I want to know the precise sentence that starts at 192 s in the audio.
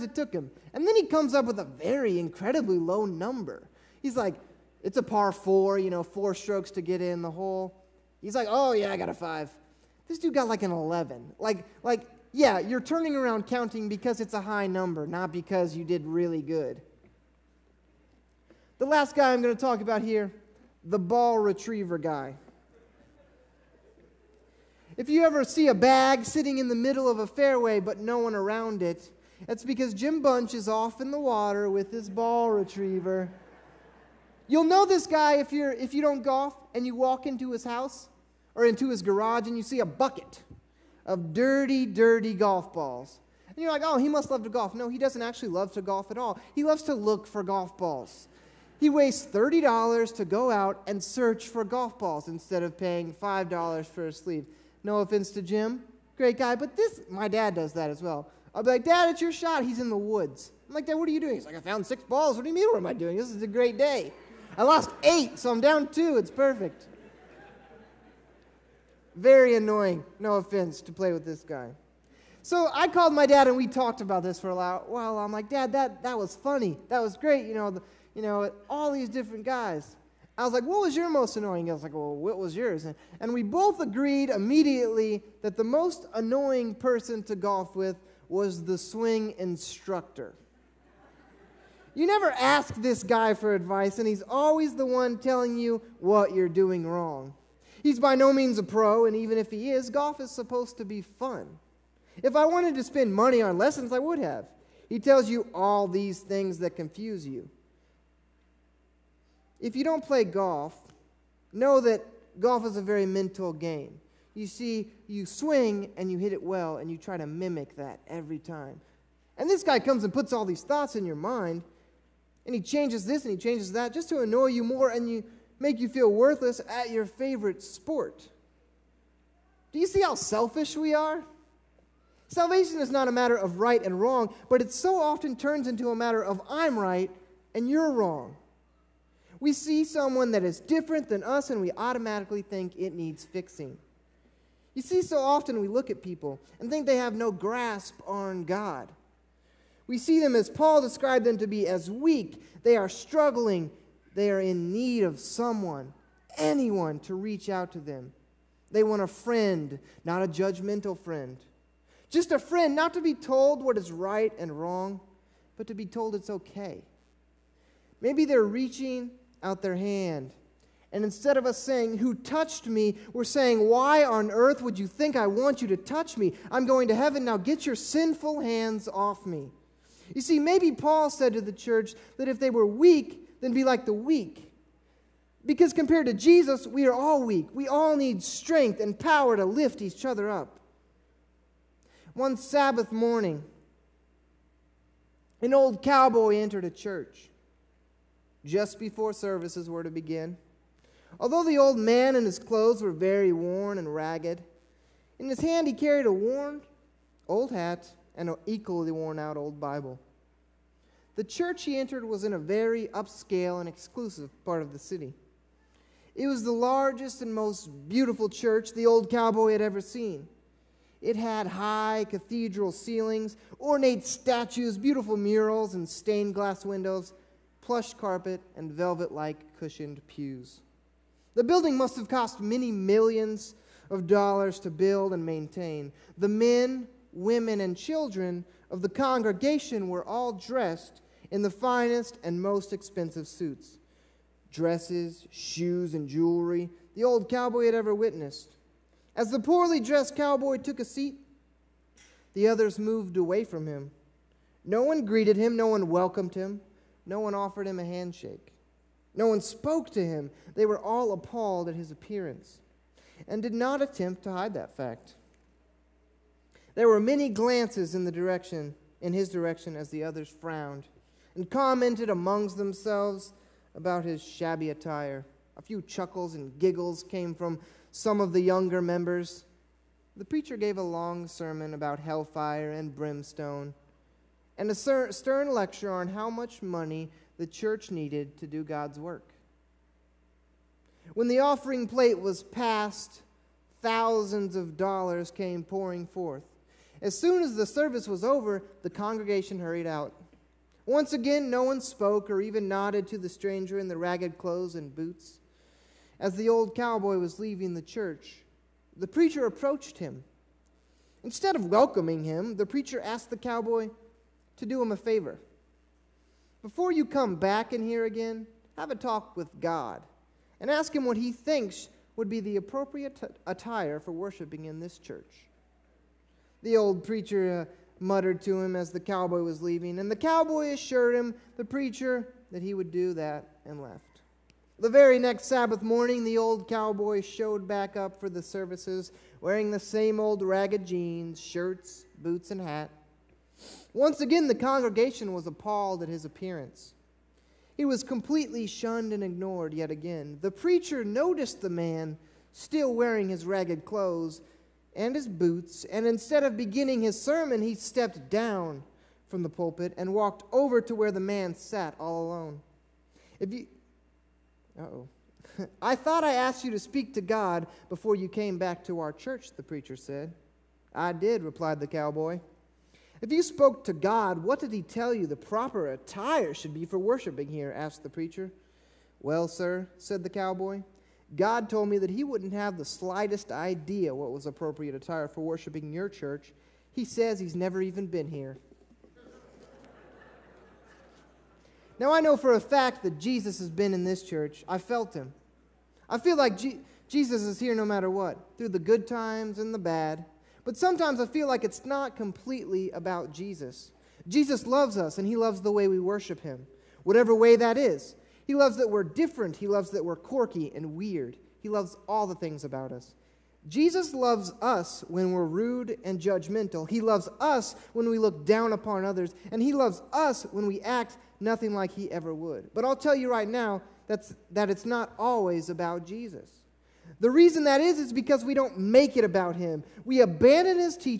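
One Sabbath morning, an old cowboy entered a church just before services were to begin.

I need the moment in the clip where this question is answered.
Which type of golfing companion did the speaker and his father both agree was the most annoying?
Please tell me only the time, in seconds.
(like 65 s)
88 s.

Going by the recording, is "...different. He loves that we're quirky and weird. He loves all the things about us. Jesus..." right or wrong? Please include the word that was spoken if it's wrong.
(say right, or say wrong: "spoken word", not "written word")
right.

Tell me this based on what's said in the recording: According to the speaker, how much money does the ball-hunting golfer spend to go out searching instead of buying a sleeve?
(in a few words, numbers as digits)
$30.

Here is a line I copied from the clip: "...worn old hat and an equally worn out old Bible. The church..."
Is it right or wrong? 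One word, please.
right.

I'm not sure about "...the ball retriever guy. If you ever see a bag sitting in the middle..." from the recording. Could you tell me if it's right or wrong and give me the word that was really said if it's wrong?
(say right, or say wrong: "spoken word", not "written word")
right.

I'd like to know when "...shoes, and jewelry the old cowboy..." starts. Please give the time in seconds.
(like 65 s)
245 s.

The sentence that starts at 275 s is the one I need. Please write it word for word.
A few chuckles and giggles came from some of the younger members.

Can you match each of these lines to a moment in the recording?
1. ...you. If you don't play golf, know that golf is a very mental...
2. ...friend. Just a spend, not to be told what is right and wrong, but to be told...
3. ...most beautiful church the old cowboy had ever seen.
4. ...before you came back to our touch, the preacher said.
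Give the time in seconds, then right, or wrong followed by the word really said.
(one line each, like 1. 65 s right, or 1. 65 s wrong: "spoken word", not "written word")
1. 107 s right
2. 160 s wrong: "friend", not "spend"
3. 217 s right
4. 367 s wrong: "church", not "touch".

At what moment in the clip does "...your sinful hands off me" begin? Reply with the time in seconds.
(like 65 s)
177 s.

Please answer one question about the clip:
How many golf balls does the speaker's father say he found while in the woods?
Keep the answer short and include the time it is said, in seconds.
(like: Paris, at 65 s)
6, at 61 s.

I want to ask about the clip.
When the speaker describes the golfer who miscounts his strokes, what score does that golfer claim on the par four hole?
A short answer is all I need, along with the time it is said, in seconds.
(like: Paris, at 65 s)
5, at 8 s.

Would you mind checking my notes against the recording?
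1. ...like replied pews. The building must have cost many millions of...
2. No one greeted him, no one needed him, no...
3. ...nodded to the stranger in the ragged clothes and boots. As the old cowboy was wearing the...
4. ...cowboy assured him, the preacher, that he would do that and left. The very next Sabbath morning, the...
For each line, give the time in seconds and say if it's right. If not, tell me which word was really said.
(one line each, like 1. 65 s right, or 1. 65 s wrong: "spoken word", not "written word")
1. 229 s wrong: "cushioned", not "replied"
2. 254 s wrong: "welcomed", not "needed"
3. 302 s wrong: "leaving", not "wearing"
4. 330 s right.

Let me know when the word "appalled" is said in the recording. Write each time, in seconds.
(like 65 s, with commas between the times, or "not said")
261 s, 345 s.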